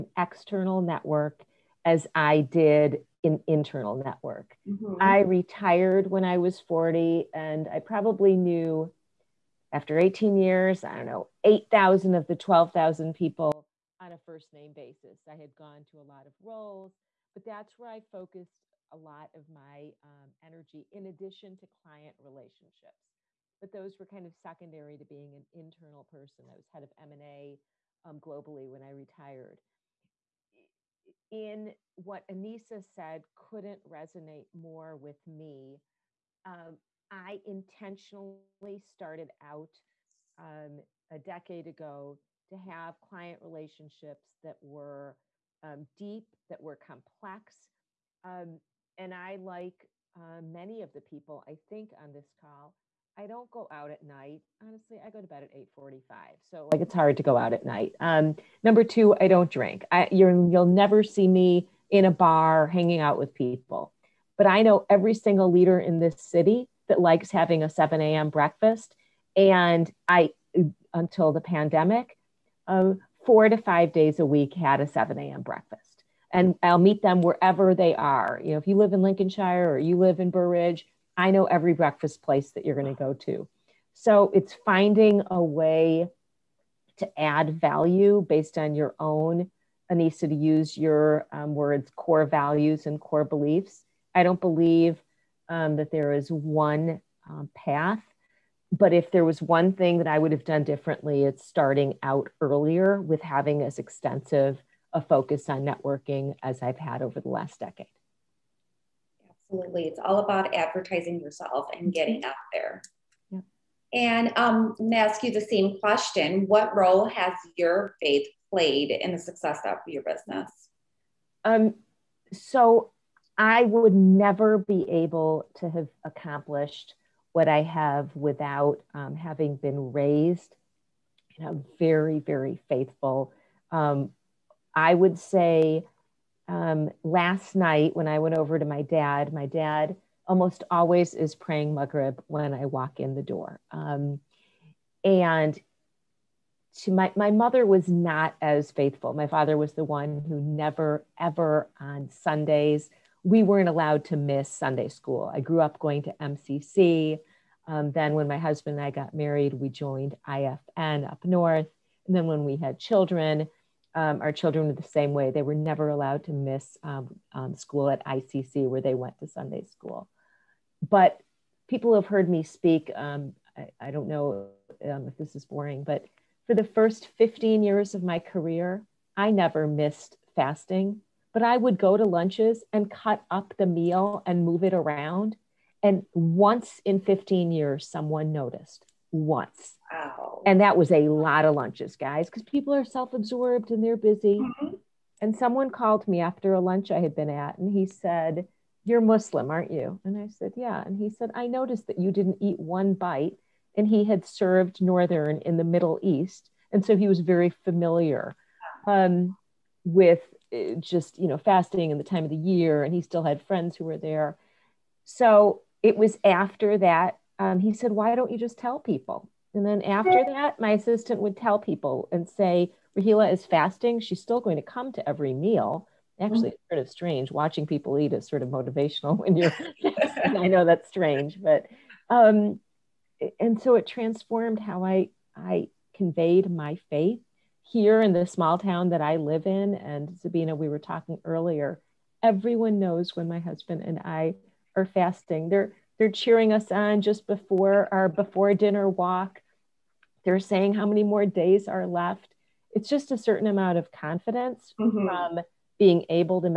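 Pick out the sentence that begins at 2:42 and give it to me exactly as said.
And then, when we had children, um, our children were the same way.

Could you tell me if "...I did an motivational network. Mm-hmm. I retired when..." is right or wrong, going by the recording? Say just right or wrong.
wrong.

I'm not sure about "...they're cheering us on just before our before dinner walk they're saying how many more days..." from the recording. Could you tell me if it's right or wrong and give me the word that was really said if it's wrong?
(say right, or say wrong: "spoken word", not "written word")
right.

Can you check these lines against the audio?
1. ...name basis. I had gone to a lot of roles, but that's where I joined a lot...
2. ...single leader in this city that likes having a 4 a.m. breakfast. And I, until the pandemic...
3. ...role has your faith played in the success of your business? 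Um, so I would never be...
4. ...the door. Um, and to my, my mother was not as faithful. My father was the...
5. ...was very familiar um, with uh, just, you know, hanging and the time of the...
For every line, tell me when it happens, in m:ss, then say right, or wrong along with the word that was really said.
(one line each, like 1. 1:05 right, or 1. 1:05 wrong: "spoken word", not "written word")
1. 0:14 wrong: "focused", not "joined"
2. 1:05 wrong: "7", not "4"
3. 1:56 right
4. 2:23 right
5. 3:27 wrong: "fasting", not "hanging".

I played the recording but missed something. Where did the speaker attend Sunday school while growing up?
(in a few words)
MCC.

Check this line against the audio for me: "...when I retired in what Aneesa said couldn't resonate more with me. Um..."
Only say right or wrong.
right.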